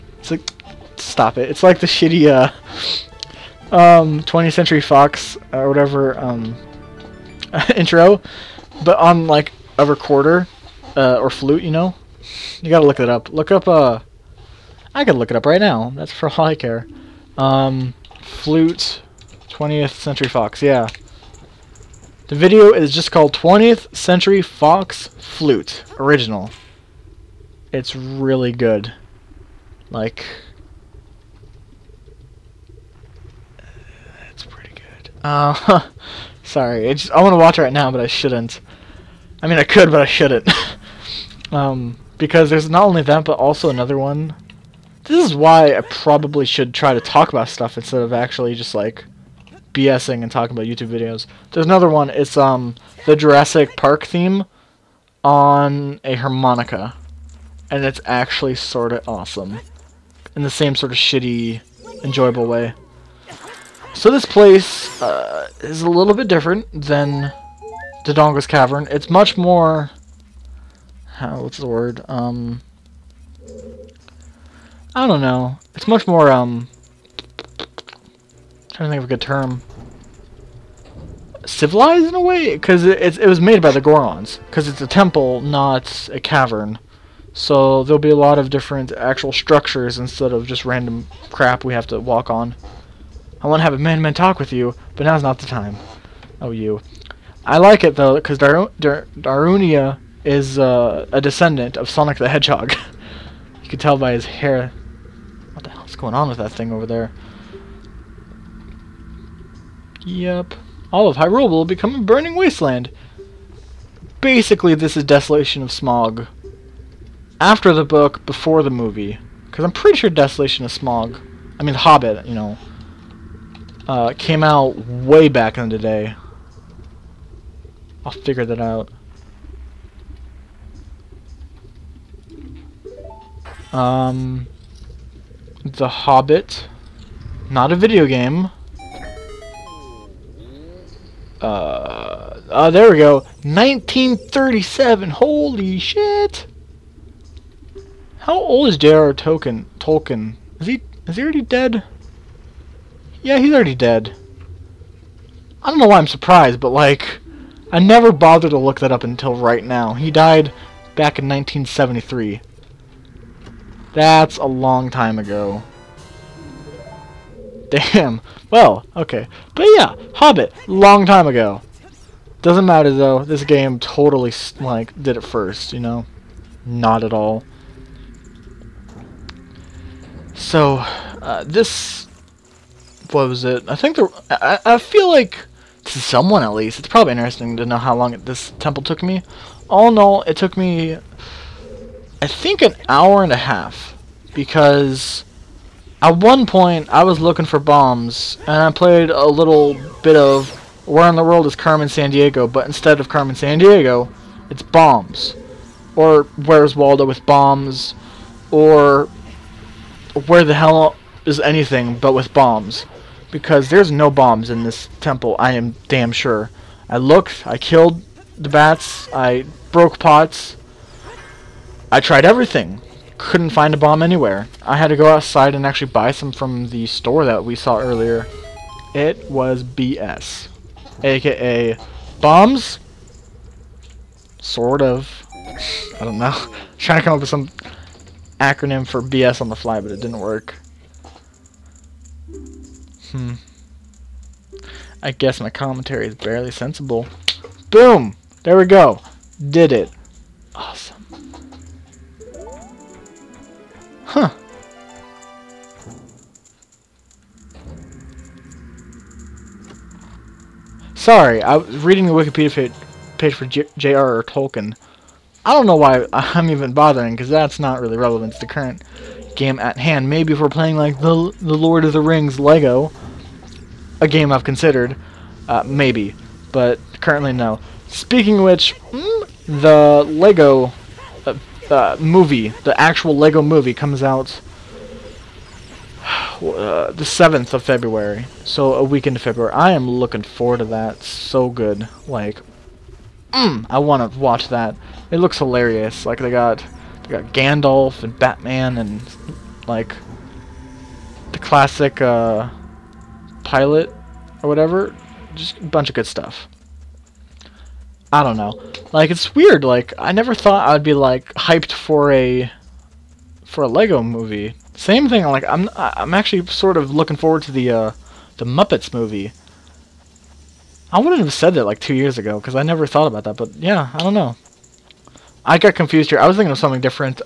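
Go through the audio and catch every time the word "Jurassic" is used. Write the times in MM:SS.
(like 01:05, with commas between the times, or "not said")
00:53.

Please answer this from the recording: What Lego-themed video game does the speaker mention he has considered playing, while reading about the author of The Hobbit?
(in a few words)
Lord of the Rings Lego.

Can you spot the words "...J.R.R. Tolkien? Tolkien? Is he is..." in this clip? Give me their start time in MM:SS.
02:28.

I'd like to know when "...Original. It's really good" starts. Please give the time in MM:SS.
00:25.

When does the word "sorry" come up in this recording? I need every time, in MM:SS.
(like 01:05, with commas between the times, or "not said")
00:36, 04:20.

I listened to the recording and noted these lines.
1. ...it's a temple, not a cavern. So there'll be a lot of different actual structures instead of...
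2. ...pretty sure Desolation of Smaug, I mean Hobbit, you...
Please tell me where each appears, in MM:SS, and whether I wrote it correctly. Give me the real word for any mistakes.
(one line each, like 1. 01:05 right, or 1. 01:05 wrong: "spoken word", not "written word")
1. 01:24 right
2. 01:59 right.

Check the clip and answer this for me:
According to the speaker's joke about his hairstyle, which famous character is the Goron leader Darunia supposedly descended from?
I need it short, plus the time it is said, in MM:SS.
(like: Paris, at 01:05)
Sonic the Hedgehog, at 01:41.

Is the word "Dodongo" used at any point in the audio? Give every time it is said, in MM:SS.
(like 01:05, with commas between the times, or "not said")
01:08.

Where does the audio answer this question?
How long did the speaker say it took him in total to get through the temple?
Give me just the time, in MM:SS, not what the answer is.
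03:12.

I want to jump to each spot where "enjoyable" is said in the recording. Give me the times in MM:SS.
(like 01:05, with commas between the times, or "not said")
01:02.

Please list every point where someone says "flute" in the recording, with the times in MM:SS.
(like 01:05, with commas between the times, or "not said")
00:11, 00:18, 00:25.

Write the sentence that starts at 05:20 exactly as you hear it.
I wouldn't have said that like two years ago because I never thought about that.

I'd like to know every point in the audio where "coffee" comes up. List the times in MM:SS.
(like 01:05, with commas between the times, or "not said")
not said.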